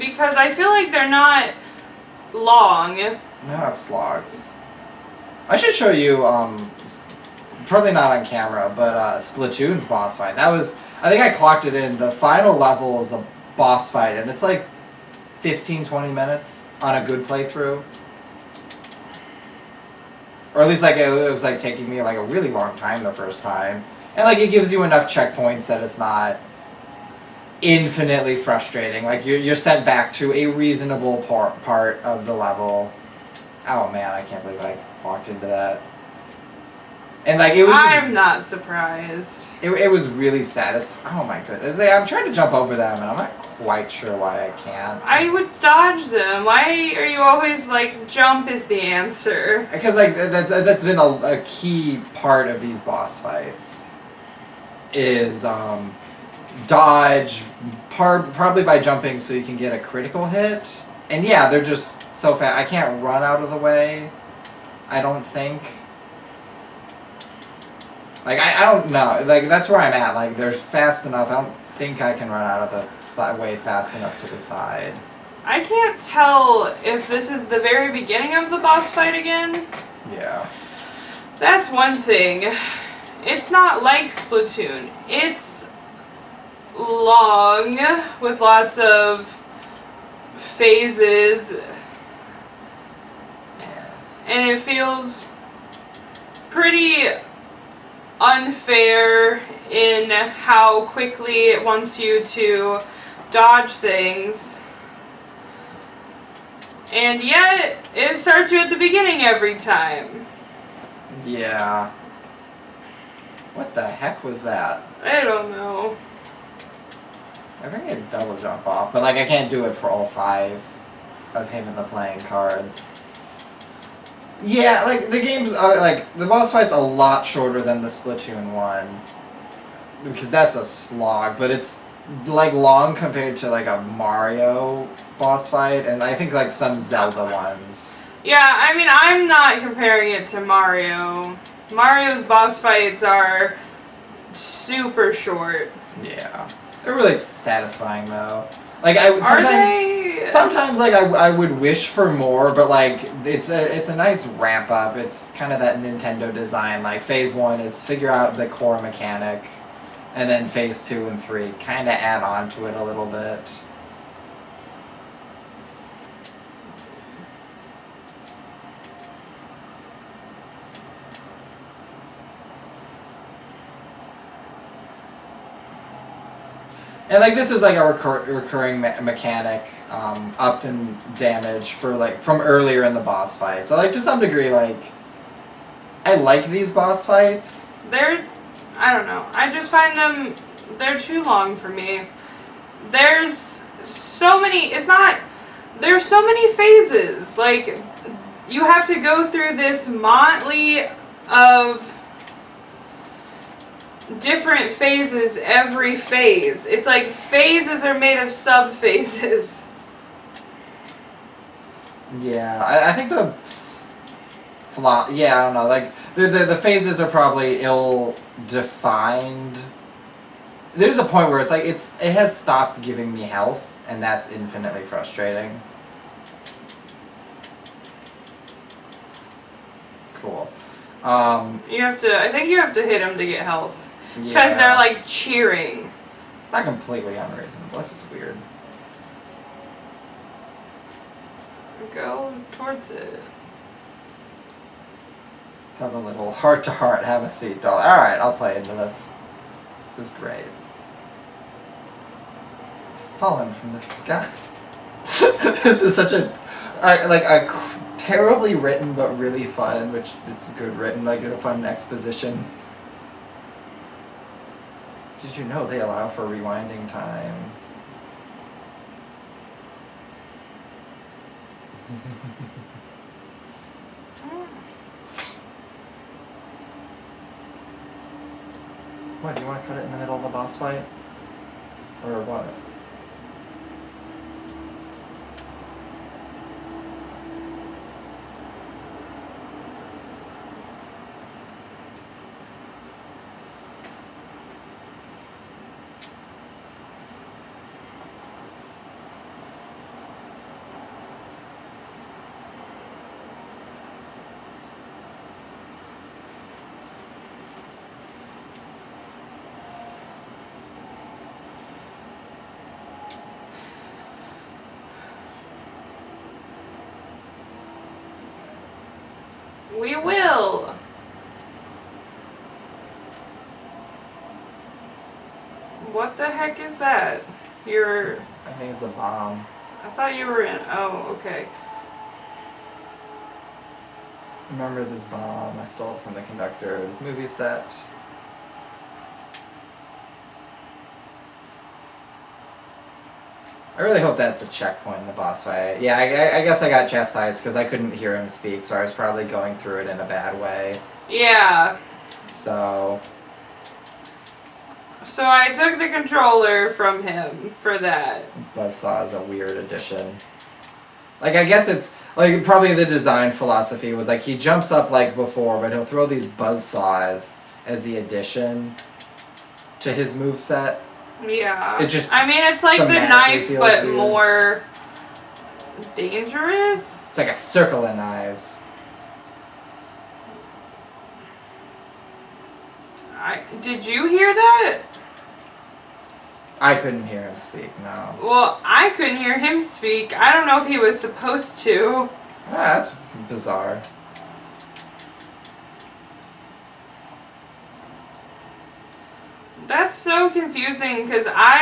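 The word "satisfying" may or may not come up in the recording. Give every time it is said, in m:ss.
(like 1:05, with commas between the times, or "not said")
0:40, 2:27.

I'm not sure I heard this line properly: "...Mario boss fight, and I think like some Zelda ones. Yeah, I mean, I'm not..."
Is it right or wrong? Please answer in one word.
right.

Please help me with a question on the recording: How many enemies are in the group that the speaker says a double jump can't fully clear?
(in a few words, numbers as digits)
5.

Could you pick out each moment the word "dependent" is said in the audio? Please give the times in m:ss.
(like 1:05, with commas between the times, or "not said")
not said.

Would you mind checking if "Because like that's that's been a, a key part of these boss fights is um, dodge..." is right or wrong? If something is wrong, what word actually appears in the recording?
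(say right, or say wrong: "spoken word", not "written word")
right.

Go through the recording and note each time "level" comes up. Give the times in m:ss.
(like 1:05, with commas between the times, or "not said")
0:12, 0:32.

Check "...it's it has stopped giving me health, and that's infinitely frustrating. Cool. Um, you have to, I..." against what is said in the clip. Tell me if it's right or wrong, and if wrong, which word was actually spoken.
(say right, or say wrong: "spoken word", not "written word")
right.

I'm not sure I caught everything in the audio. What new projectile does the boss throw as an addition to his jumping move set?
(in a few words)
Buzzsaws.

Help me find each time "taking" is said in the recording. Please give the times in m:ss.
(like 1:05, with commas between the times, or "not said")
0:21.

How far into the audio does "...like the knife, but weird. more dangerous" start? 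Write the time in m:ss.
6:12.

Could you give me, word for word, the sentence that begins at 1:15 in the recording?
I can't tell if this is the very beginning of the boss fight again.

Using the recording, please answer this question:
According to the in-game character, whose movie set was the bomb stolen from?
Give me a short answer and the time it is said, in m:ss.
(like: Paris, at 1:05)
The conductor, at 5:36.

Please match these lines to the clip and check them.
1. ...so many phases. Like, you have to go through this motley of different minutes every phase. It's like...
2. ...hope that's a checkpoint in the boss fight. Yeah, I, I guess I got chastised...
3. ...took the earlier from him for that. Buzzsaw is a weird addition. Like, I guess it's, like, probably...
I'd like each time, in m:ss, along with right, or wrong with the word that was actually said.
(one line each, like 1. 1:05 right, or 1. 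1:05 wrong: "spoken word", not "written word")
1. 3:16 wrong: "phases", not "minutes"
2. 5:44 right
3. 5:55 wrong: "controller", not "earlier".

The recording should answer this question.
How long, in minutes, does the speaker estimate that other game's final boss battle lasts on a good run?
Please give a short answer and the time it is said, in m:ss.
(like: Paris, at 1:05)
15-20 minutes, at 0:15.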